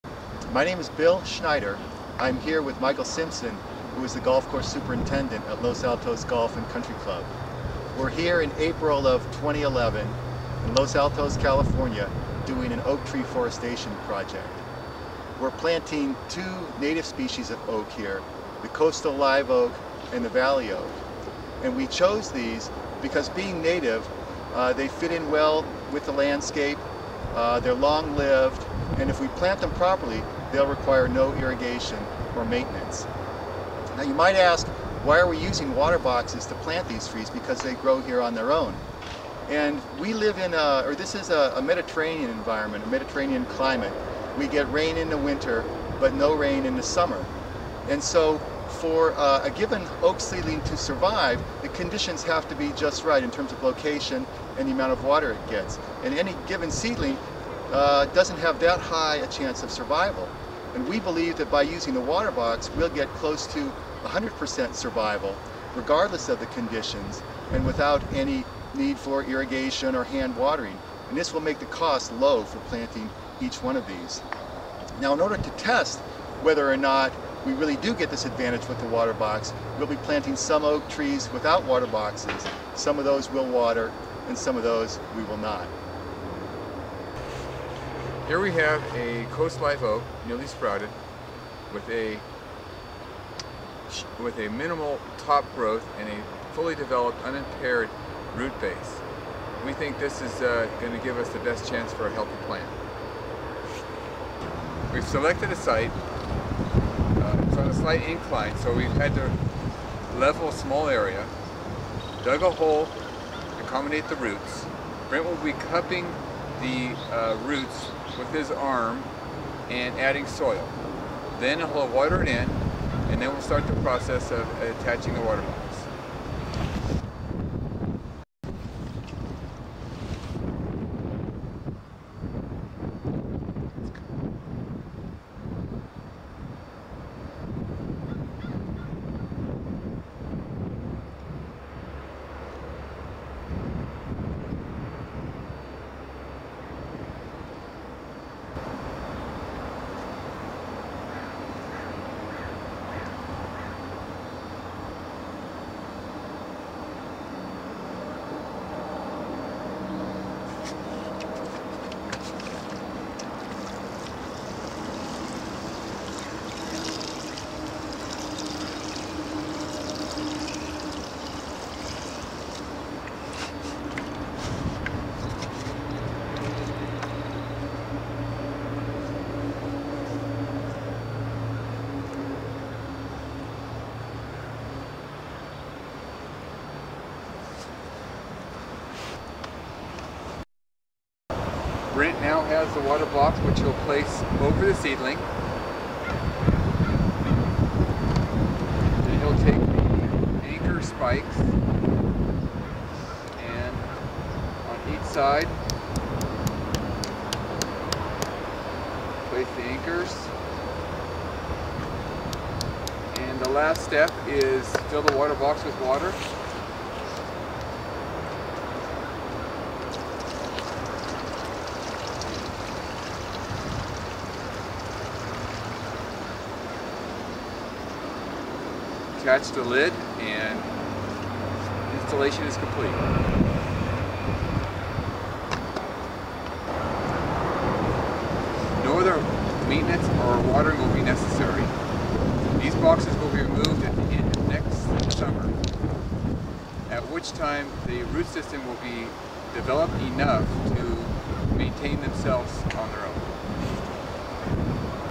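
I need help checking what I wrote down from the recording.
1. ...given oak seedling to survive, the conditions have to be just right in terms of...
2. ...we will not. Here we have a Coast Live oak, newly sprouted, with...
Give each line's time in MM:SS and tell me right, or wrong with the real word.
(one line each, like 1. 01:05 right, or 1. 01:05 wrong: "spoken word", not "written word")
1. 00:49 right
2. 01:25 right.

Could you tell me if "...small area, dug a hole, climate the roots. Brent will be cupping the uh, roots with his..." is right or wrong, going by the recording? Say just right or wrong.
wrong.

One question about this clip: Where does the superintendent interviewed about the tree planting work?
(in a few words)
Los Altos Golf and Country Club.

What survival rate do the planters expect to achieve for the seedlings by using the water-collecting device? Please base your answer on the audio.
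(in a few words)
close to 100%.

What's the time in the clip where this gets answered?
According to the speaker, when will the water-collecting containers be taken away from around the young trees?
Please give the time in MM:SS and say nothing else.
04:04.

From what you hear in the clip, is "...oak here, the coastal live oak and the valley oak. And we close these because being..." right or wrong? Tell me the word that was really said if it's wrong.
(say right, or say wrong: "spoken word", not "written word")
wrong: "chose", not "close".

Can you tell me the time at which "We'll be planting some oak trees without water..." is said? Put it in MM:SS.
01:19.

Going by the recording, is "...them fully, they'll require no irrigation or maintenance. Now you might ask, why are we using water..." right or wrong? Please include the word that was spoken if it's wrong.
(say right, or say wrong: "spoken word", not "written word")
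wrong: "properly", not "fully".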